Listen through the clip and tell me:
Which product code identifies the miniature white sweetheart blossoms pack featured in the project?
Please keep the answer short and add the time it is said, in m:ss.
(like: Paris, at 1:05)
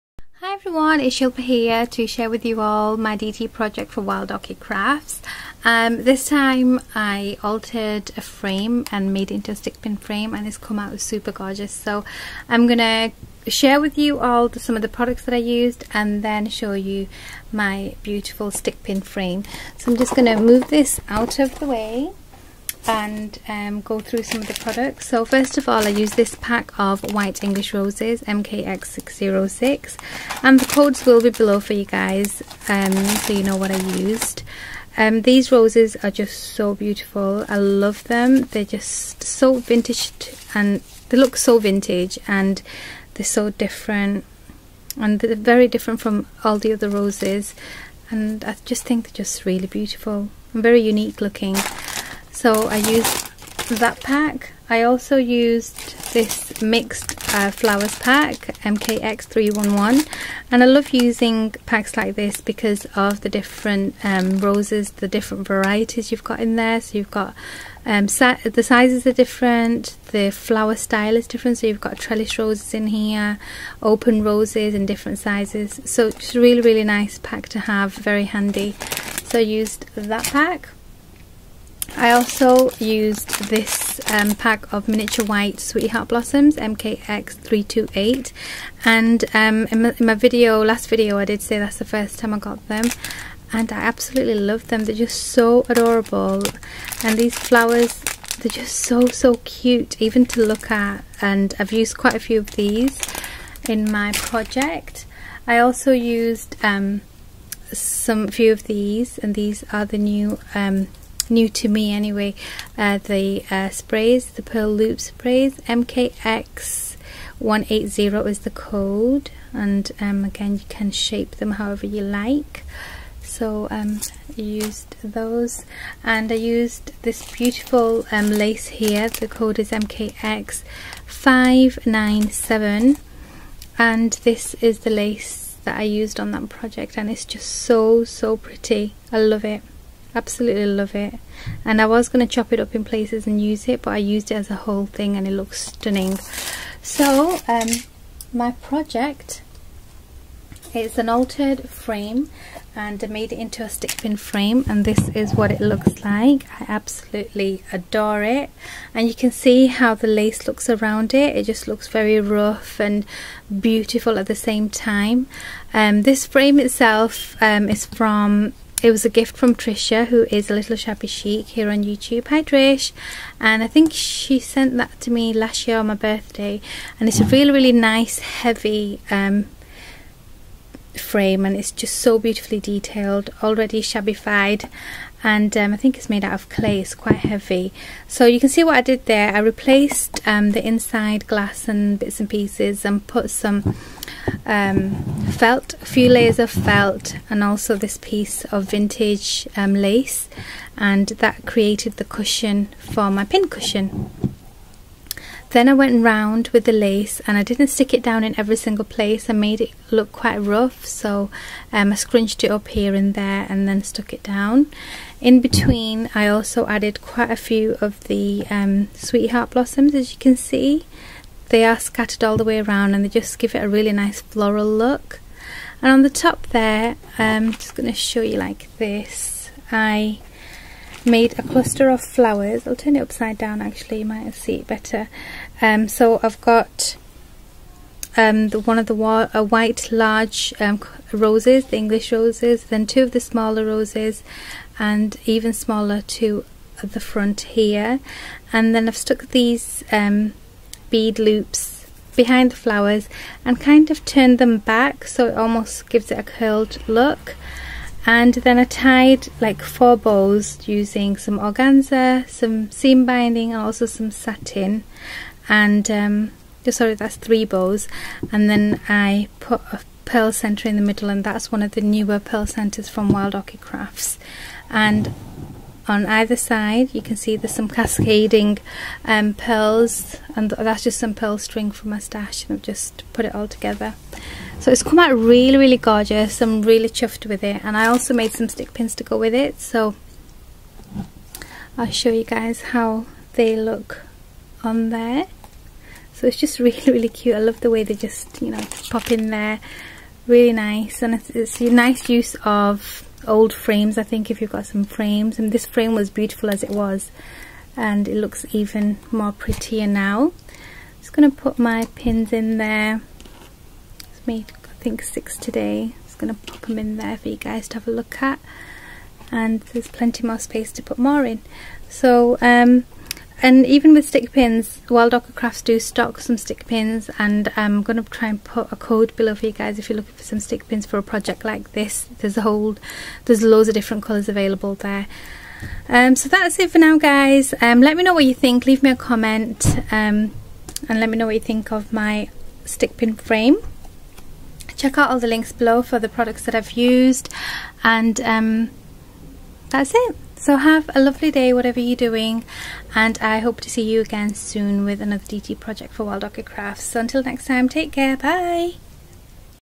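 MKX328, at 1:26.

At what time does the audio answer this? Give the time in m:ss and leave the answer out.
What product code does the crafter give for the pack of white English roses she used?
0:28.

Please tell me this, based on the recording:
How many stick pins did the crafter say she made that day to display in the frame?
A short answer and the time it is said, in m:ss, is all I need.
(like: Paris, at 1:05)
6, at 5:15.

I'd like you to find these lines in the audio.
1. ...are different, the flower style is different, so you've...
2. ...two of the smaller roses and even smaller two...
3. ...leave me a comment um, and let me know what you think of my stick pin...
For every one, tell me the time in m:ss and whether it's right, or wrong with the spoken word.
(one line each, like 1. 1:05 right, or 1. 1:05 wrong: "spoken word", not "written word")
1. 1:09 right
2. 4:02 right
3. 5:38 right.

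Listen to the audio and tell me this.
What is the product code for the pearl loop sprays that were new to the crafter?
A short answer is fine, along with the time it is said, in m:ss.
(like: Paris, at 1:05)
MKX180, at 1:55.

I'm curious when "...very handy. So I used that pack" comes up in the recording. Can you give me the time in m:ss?
1:17.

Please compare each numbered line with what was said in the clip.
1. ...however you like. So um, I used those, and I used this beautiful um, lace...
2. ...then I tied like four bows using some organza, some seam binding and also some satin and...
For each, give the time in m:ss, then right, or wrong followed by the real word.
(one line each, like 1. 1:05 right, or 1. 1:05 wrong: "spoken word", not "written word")
1. 2:01 right
2. 4:18 right.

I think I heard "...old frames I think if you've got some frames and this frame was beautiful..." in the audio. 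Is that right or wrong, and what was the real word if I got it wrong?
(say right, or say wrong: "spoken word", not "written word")
right.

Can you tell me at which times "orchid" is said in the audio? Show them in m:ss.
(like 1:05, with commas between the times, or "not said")
0:04, 4:33, 5:25, 5:56.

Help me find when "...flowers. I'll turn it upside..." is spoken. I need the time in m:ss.
3:52.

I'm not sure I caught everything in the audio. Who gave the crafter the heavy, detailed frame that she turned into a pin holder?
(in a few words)
Trisha.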